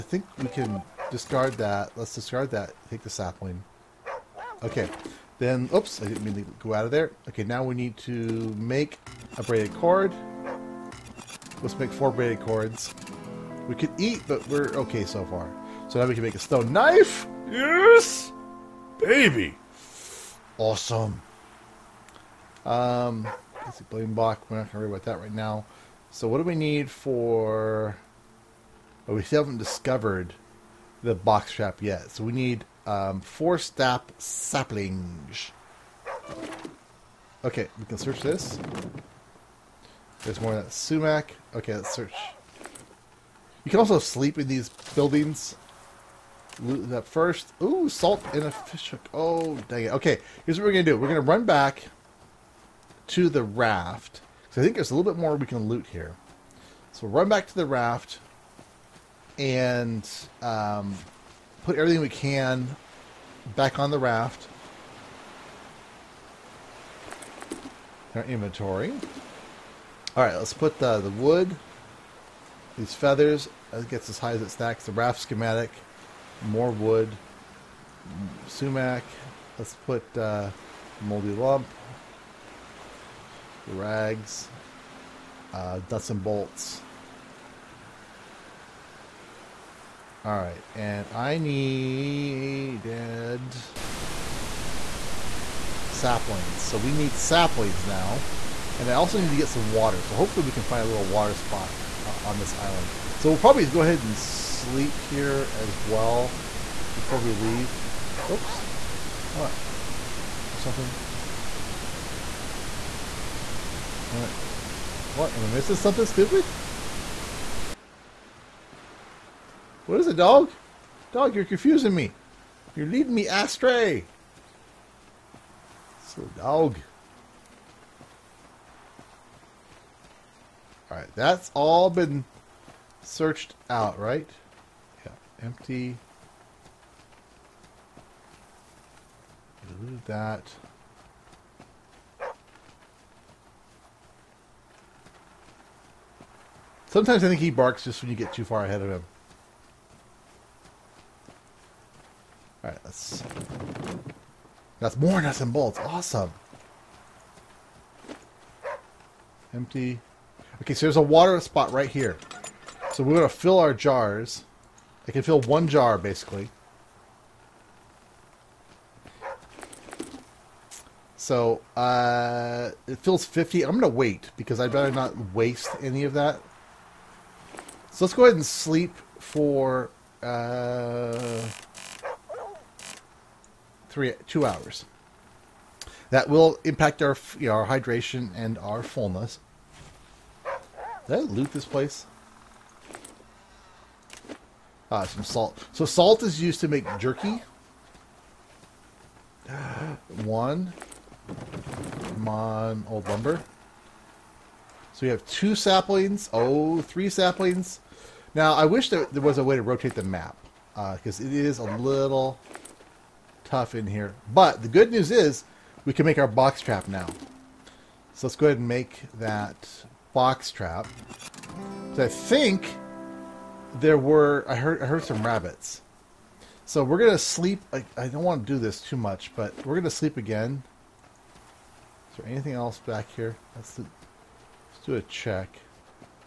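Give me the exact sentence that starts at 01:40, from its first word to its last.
So hopefully we can find a little water spot uh, on this island.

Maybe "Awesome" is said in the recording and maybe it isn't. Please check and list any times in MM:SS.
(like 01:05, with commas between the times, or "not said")
00:20, 02:35.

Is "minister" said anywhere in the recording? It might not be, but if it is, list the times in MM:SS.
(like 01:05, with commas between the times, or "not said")
not said.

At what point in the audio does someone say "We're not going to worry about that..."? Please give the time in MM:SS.
00:24.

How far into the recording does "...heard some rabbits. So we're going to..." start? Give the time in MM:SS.
03:44.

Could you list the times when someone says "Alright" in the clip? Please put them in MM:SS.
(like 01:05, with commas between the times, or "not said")
02:10, 02:32.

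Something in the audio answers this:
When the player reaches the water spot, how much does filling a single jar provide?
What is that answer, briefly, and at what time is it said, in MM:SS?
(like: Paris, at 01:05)
50, at 02:53.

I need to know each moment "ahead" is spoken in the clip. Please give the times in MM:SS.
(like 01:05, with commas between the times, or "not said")
01:43, 02:28, 02:58, 03:38.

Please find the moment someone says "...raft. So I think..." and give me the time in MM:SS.
00:53.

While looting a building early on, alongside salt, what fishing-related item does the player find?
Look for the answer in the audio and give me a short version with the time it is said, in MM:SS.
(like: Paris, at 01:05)
fish hook, at 00:48.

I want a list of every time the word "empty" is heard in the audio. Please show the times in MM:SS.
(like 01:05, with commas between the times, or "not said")
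02:15, 02:39.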